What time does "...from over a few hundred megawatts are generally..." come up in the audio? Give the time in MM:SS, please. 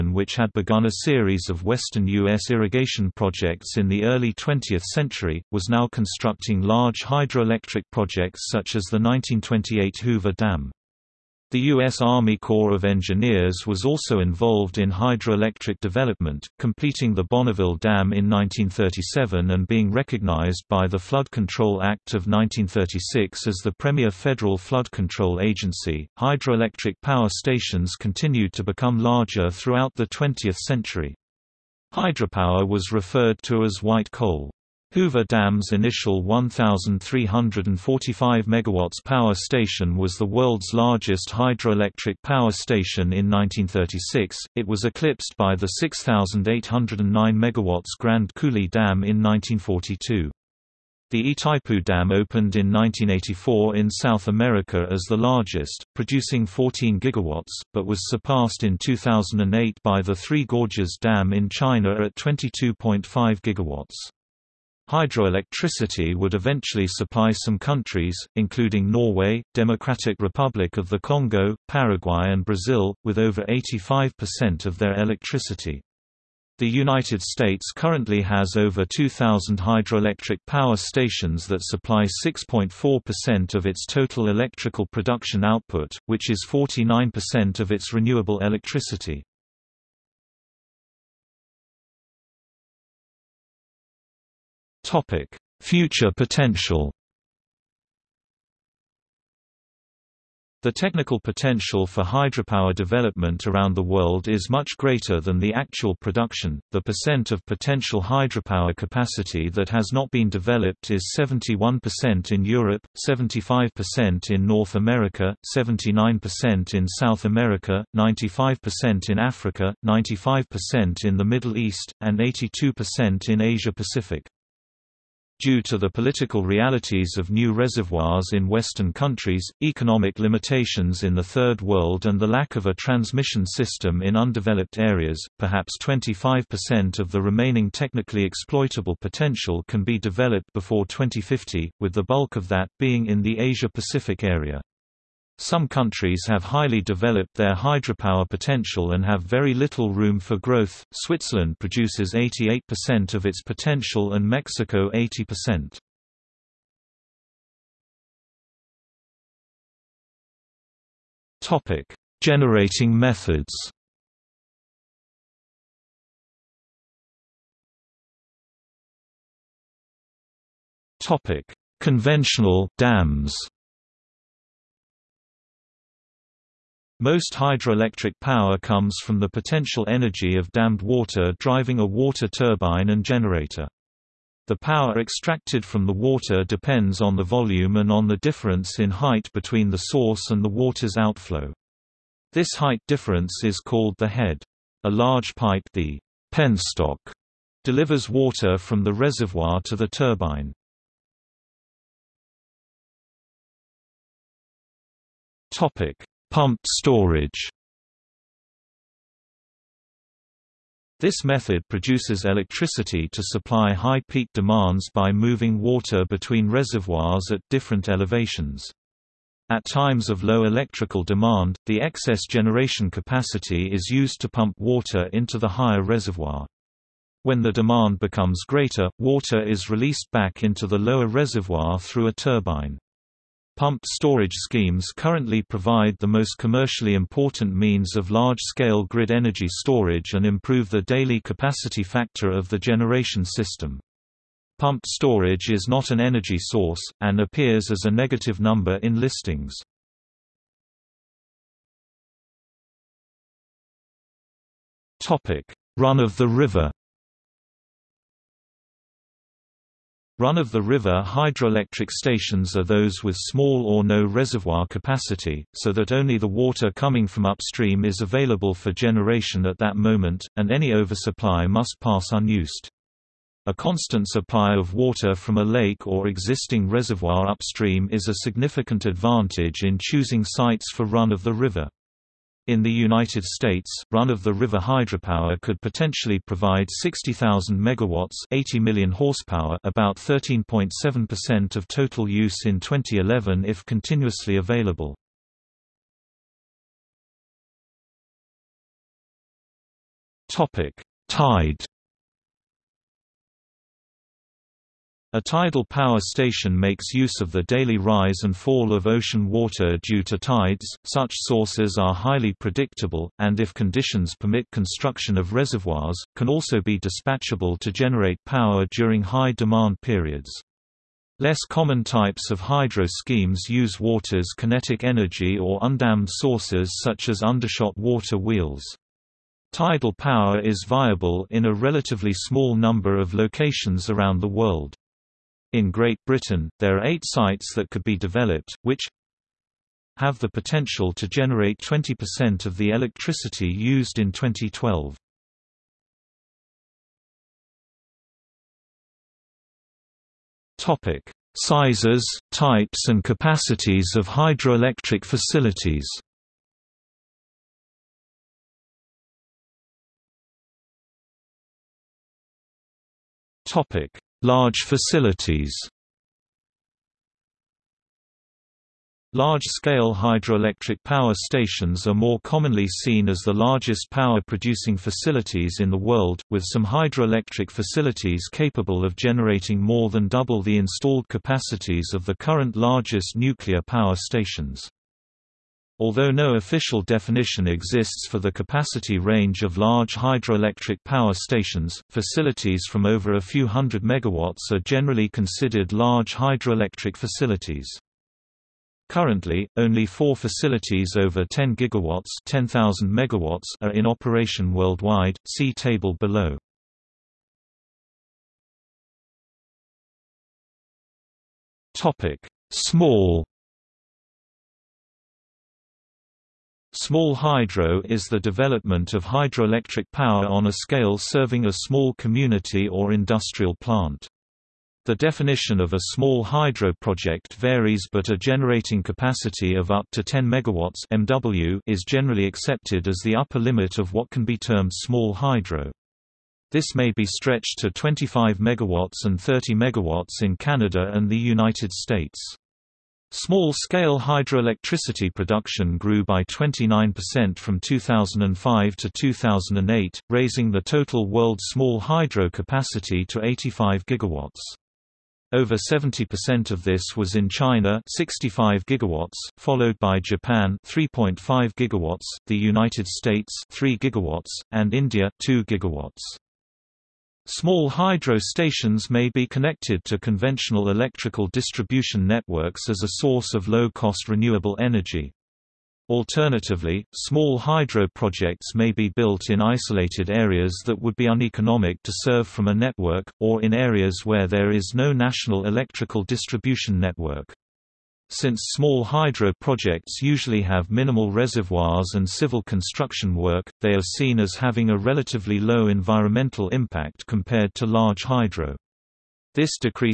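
06:32.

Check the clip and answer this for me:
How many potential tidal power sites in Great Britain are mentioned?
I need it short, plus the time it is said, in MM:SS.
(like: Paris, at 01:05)
8, at 05:36.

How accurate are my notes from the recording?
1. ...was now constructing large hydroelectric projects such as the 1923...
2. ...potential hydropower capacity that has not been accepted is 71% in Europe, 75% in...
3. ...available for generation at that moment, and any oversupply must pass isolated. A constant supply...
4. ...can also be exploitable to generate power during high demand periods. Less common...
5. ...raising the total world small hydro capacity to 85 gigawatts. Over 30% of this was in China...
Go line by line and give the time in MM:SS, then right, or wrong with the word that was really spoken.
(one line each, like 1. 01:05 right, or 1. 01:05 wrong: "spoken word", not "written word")
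1. 00:05 wrong: "1928", not "1923"
2. 01:47 wrong: "developed", not "accepted"
3. 04:27 wrong: "unused", not "isolated"
4. 05:16 wrong: "dispatchable", not "exploitable"
5. 07:30 wrong: "70", not "30".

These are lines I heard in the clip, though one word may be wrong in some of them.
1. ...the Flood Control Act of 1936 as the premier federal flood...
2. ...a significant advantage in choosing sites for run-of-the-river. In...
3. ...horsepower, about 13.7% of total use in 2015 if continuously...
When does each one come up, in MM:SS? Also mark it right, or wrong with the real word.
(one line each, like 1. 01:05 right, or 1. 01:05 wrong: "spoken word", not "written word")
1. 00:20 right
2. 04:38 right
3. 04:48 wrong: "2011", not "2015".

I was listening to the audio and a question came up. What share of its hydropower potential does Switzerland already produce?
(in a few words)
88%.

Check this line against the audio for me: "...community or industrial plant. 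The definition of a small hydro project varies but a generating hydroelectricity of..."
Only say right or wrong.
wrong.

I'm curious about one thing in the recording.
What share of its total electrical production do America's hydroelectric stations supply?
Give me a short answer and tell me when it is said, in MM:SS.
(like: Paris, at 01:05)
6.4%, at 01:22.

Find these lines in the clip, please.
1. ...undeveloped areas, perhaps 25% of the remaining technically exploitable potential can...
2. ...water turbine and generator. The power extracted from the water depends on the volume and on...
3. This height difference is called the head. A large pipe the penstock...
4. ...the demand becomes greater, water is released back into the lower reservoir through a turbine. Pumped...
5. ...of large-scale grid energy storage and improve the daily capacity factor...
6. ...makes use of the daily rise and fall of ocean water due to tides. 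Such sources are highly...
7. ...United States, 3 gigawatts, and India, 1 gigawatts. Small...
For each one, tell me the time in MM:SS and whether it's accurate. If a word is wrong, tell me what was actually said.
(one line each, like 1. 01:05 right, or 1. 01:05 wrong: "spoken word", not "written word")
1. 02:14 right
2. 03:01 right
3. 03:12 right
4. 03:47 right
5. 03:57 right
6. 05:06 right
7. 07:42 wrong: "2", not "1".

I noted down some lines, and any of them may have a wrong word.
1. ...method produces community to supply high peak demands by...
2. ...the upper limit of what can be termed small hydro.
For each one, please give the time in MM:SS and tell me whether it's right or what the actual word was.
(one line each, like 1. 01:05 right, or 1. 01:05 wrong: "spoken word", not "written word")
1. 03:31 wrong: "electricity", not "community"
2. 07:13 right.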